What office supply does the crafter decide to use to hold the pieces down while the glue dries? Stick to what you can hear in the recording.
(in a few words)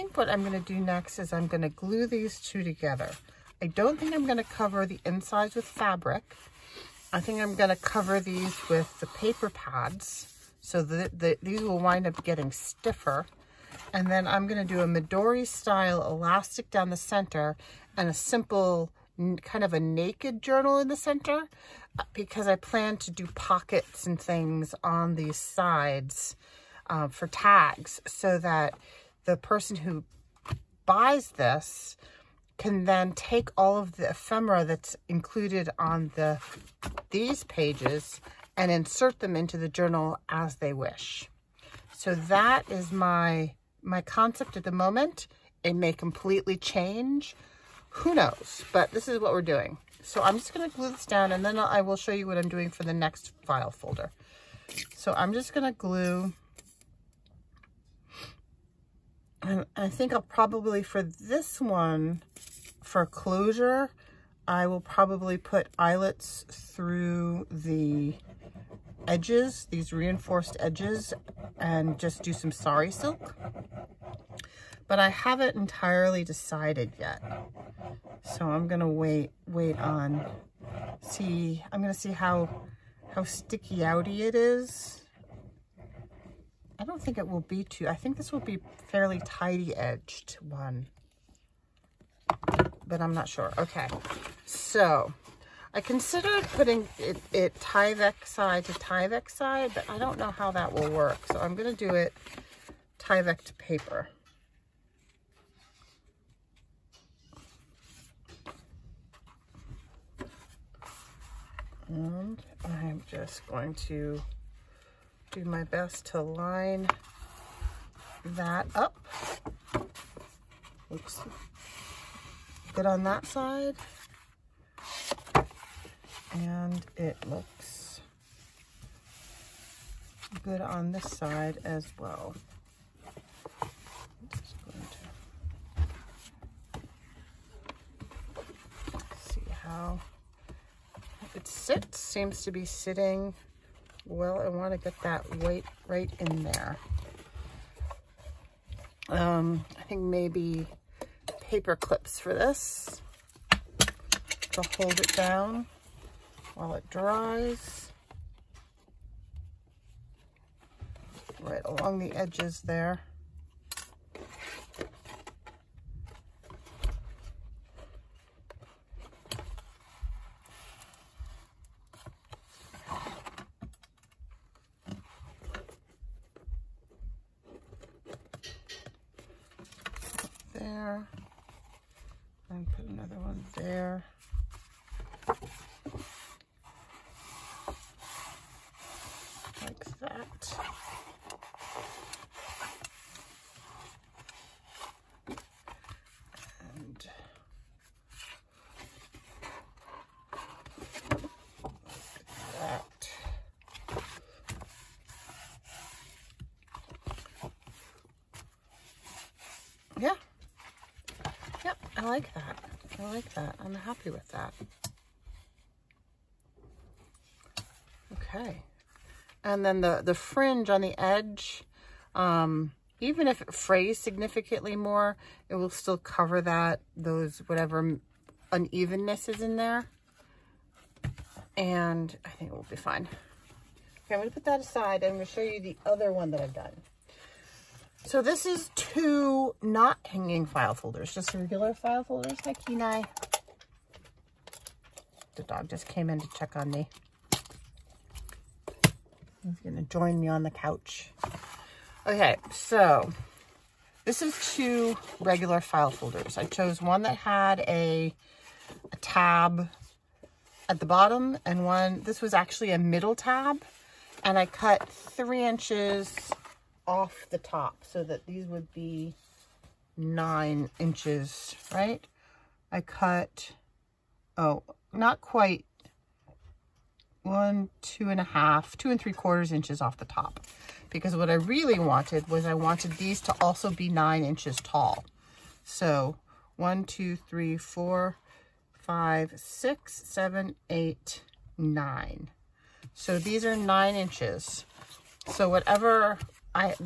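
paper clips.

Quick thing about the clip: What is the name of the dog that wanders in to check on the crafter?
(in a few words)
Kenai.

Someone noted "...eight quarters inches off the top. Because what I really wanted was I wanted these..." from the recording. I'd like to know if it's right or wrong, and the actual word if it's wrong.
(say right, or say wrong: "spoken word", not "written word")
wrong: "three", not "eight".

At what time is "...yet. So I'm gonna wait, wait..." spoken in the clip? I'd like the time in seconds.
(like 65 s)
76 s.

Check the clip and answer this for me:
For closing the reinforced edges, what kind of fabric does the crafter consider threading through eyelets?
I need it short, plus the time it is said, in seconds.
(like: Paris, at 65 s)
sari silk, at 72 s.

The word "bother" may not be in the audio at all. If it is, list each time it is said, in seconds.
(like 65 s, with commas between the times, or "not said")
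not said.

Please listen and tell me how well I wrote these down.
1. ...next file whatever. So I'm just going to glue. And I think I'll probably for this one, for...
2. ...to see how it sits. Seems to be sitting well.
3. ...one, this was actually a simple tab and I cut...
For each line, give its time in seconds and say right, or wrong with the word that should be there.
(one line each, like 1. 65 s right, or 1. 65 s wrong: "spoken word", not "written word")
1. 52 s wrong: "folder", not "whatever"
2. 138 s right
3. 261 s wrong: "middle", not "simple".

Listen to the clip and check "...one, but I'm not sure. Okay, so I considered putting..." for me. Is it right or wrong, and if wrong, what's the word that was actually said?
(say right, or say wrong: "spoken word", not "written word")
right.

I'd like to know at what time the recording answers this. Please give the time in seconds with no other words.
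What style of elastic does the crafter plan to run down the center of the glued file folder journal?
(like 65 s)
14 s.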